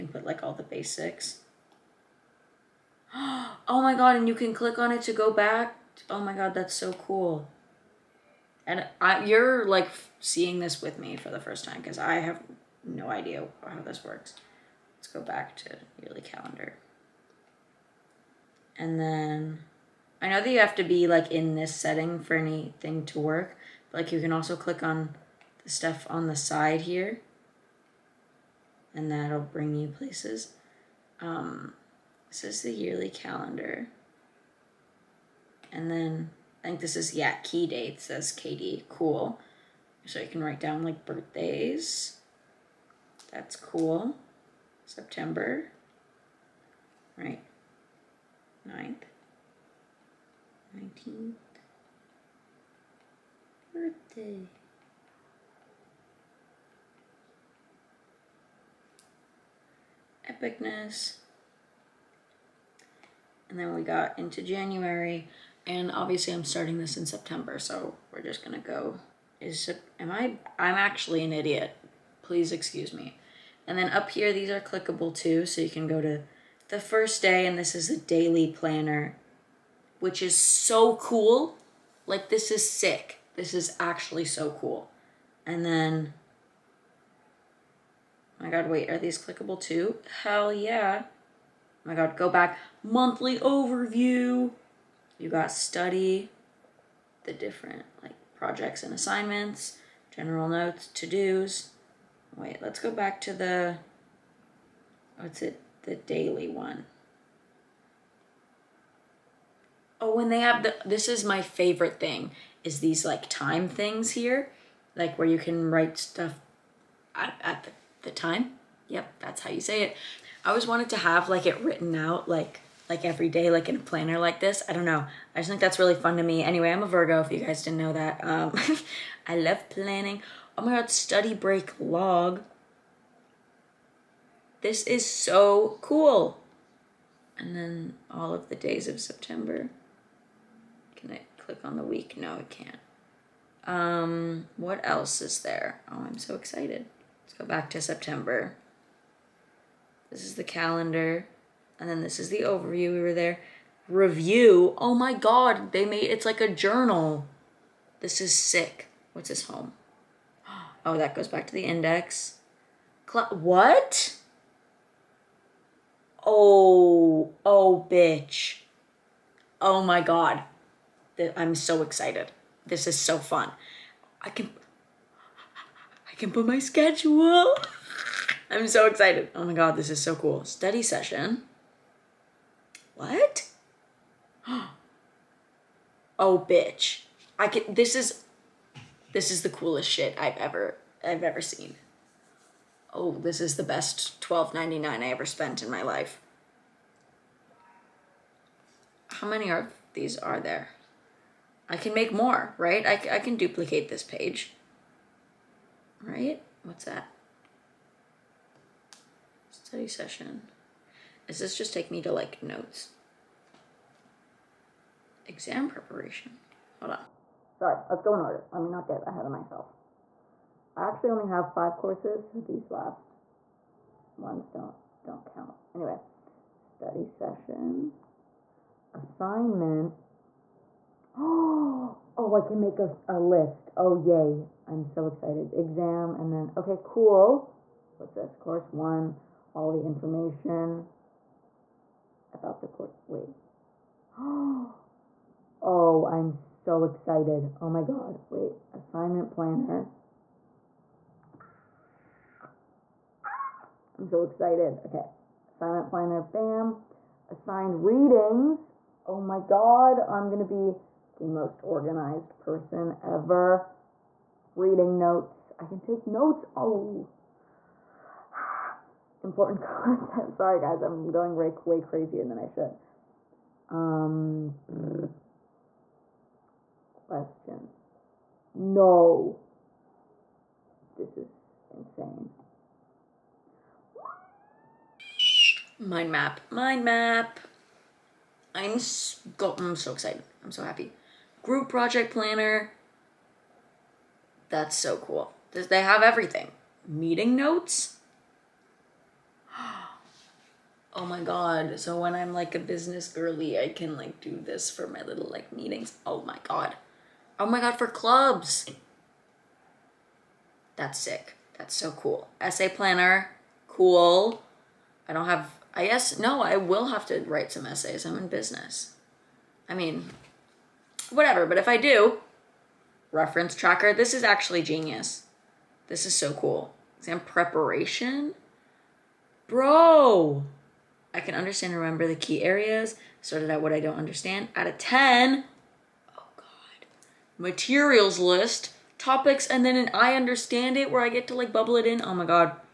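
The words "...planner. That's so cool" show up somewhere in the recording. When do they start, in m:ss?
4:52.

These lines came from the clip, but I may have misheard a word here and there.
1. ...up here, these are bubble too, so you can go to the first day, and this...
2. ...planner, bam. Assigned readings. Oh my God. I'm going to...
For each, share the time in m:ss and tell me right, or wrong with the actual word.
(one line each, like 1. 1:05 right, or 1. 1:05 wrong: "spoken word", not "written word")
1. 1:13 wrong: "clickable", not "bubble"
2. 4:15 right.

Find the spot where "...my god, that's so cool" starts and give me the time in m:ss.
0:06.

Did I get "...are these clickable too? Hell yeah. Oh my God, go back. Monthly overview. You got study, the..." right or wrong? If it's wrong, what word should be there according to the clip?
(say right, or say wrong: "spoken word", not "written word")
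right.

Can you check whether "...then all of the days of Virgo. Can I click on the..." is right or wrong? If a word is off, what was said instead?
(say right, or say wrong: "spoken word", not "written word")
wrong: "September", not "Virgo".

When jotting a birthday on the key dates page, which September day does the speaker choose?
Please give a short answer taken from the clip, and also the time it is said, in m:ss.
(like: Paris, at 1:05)
19th, at 0:51.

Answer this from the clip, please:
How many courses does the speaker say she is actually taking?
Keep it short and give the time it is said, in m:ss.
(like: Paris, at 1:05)
5, at 3:41.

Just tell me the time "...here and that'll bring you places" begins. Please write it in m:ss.
0:26.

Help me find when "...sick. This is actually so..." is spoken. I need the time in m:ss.
1:22.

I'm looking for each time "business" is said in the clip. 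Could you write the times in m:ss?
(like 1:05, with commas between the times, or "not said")
5:02, 5:18.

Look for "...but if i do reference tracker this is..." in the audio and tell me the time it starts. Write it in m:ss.
5:21.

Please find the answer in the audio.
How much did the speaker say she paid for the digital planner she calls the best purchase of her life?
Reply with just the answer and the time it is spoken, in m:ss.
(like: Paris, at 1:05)
$12.99, at 3:14.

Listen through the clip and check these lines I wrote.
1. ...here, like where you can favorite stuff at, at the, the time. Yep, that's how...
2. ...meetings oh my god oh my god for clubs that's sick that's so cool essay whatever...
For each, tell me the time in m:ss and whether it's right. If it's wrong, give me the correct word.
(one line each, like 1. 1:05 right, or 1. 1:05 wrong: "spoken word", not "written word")
1. 1:54 wrong: "write", not "favorite"
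2. 5:05 wrong: "planner", not "whatever".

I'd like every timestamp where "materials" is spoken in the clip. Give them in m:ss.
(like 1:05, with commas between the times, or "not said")
5:37.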